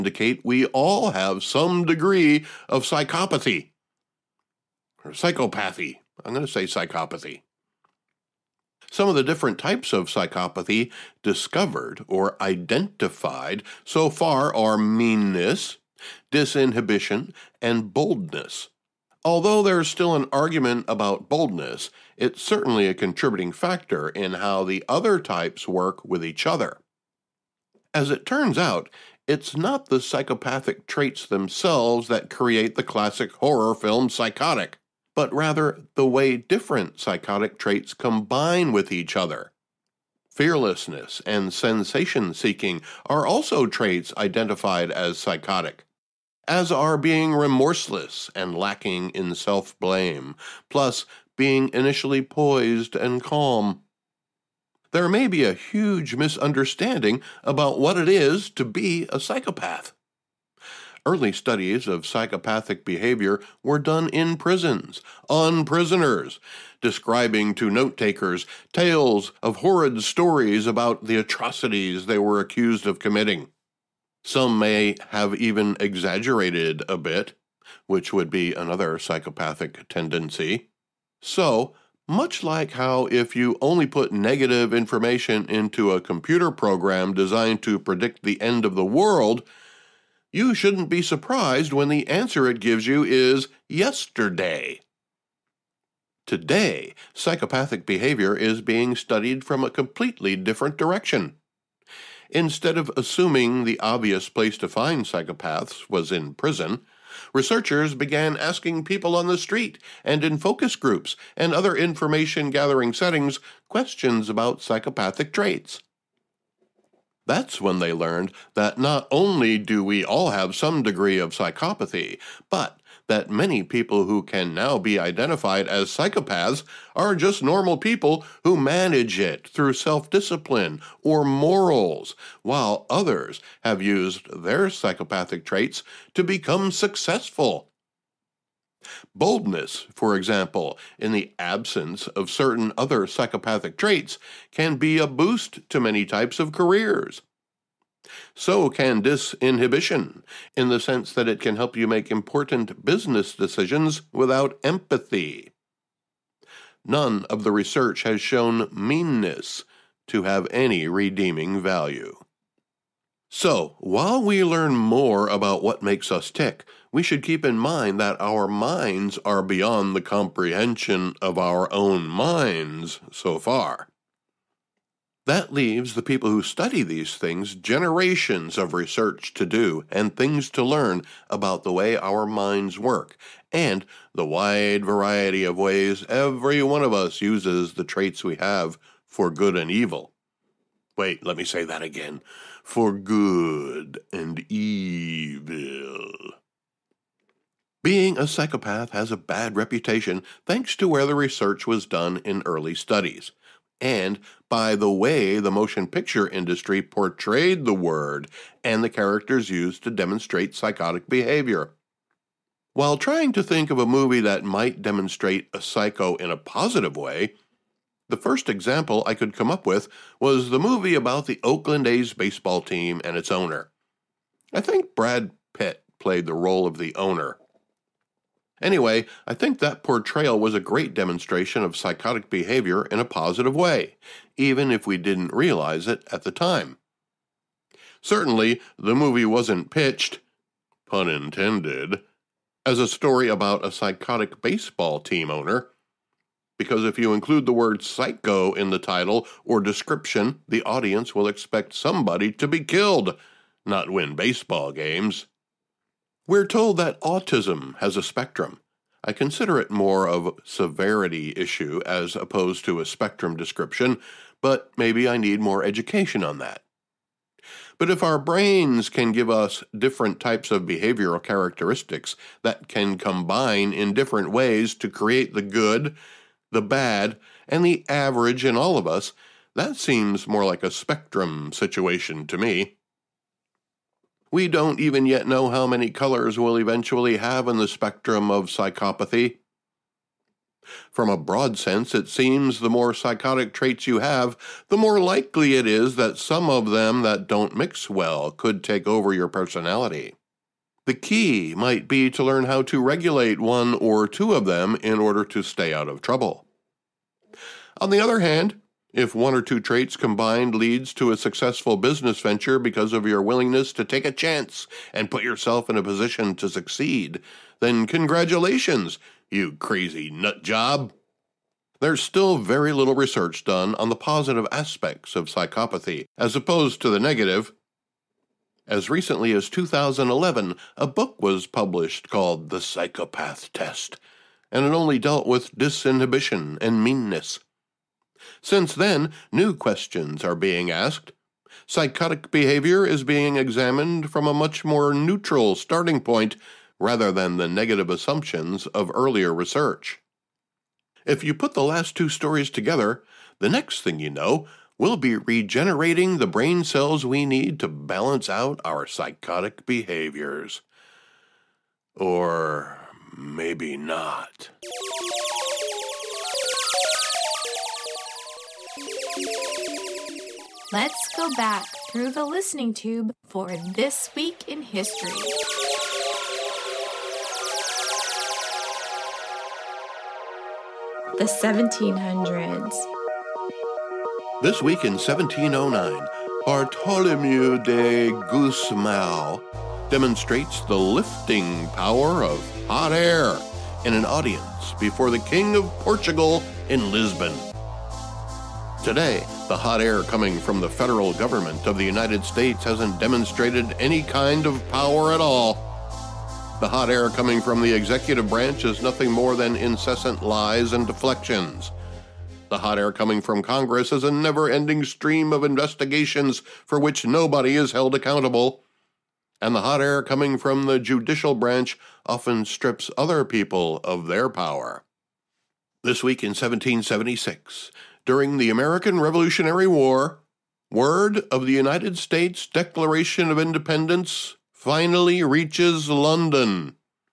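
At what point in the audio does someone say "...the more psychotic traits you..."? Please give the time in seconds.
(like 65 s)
292 s.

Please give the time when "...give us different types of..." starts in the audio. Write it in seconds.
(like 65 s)
269 s.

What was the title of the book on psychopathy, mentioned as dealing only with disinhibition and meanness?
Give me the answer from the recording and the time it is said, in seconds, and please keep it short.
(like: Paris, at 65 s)
The Psychopath Test, at 332 s.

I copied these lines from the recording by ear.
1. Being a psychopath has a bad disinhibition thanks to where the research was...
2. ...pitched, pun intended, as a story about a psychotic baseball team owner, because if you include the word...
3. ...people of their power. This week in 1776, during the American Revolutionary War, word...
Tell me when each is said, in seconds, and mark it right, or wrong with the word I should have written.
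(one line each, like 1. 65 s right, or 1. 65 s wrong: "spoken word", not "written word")
1. 197 s wrong: "reputation", not "disinhibition"
2. 239 s right
3. 423 s right.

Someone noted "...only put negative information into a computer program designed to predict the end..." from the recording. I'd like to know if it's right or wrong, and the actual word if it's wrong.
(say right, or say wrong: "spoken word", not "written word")
right.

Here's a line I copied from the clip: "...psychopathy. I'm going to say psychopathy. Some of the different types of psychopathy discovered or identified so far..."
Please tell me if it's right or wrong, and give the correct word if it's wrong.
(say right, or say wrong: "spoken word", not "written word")
right.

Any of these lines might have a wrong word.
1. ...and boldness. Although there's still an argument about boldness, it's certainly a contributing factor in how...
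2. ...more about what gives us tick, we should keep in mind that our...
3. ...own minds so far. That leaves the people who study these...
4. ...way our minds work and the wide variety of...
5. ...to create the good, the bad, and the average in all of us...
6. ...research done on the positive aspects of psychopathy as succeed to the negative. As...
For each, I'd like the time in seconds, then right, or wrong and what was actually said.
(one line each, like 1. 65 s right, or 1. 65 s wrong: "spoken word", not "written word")
1. 17 s right
2. 164 s wrong: "makes", not "gives"
3. 171 s right
4. 181 s right
5. 274 s right
6. 322 s wrong: "opposed", not "succeed".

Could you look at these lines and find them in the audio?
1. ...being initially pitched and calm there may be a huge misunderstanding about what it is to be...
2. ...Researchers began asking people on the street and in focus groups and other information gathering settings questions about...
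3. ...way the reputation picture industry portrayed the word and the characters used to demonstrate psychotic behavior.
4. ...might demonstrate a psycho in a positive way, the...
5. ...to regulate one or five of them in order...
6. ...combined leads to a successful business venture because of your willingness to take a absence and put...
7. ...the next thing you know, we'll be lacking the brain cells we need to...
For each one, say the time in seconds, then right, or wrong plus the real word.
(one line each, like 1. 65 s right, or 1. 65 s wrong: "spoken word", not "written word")
1. 51 s wrong: "poised", not "pitched"
2. 107 s right
3. 204 s wrong: "motion", not "reputation"
4. 214 s right
5. 302 s wrong: "two", not "five"
6. 309 s wrong: "chance", not "absence"
7. 353 s wrong: "regenerating", not "lacking".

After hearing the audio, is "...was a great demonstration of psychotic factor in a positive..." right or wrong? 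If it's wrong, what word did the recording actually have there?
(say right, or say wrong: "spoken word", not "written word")
wrong: "behavior", not "factor".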